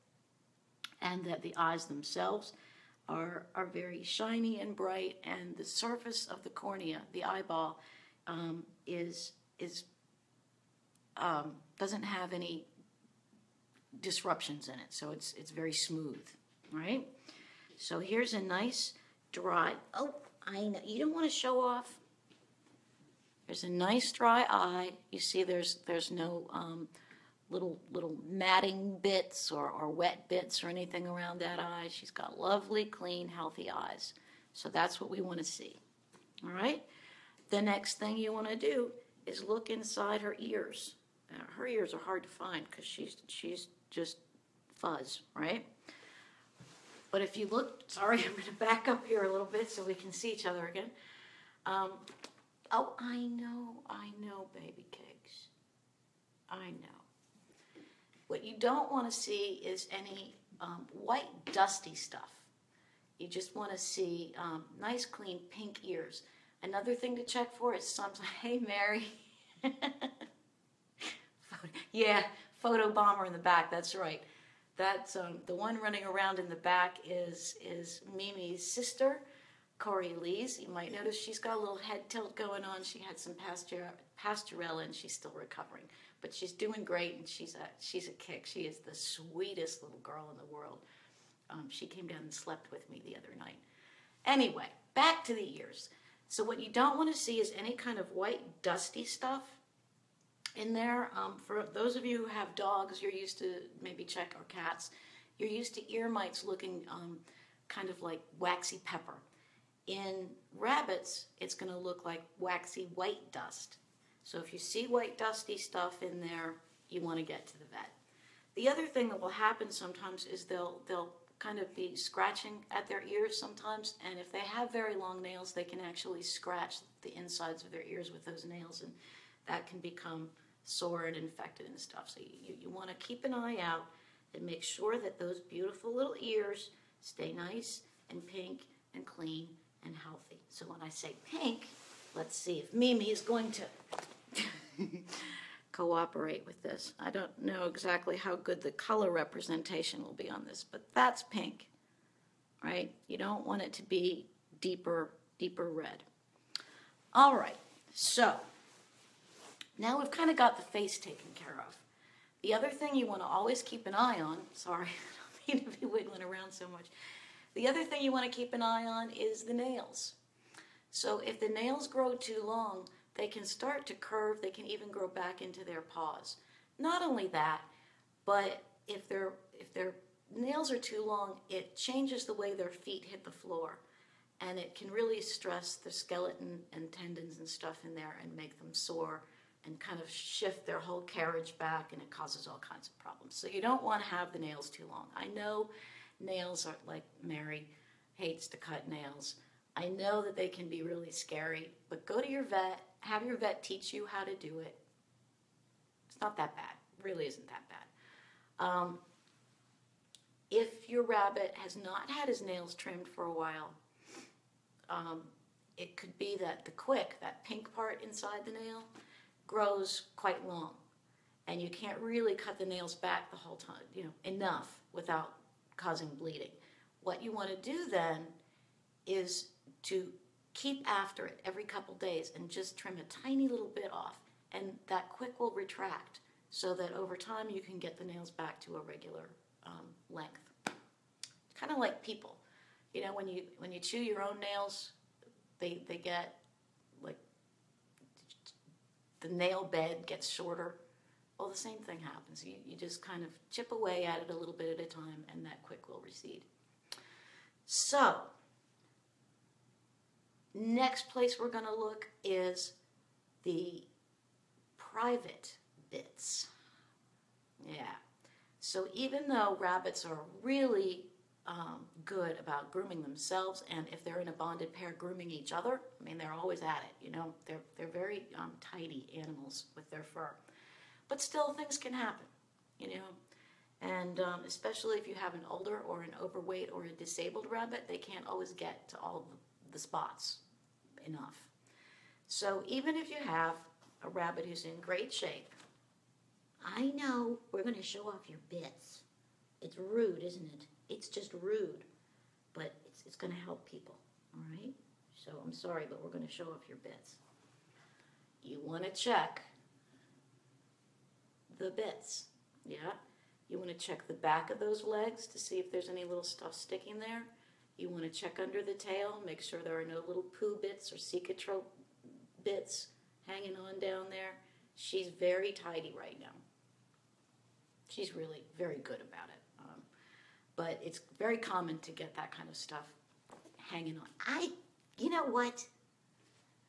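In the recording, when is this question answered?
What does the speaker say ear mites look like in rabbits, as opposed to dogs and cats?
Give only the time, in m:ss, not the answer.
1:52.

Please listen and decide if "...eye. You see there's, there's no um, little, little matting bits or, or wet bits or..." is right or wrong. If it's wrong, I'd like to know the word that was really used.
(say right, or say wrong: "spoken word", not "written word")
right.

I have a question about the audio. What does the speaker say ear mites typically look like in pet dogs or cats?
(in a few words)
waxy pepper.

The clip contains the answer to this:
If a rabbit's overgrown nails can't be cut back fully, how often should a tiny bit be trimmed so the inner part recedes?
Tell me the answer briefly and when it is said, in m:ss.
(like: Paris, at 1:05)
every couple days, at 3:51.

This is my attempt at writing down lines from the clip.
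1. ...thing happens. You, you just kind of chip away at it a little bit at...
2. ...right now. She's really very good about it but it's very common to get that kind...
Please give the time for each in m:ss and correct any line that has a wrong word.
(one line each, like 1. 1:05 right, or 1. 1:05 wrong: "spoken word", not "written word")
1. 4:11 right
2. 5:25 right.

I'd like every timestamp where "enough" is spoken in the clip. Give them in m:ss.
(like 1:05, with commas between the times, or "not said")
3:44, 4:51.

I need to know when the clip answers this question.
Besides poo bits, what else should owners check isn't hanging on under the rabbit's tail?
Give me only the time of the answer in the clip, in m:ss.
5:20.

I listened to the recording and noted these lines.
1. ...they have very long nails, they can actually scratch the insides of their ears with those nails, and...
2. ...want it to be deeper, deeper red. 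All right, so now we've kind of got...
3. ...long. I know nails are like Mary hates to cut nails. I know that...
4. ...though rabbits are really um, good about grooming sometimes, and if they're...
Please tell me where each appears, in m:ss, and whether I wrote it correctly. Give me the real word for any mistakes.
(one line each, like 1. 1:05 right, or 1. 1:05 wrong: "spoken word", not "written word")
1. 2:04 right
2. 2:33 right
3. 3:14 right
4. 4:29 wrong: "themselves", not "sometimes".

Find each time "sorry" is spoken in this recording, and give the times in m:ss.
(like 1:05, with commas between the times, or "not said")
0:47, 2:44, 5:05.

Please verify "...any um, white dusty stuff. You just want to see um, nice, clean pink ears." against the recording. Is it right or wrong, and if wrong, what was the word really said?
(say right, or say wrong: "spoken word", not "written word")
right.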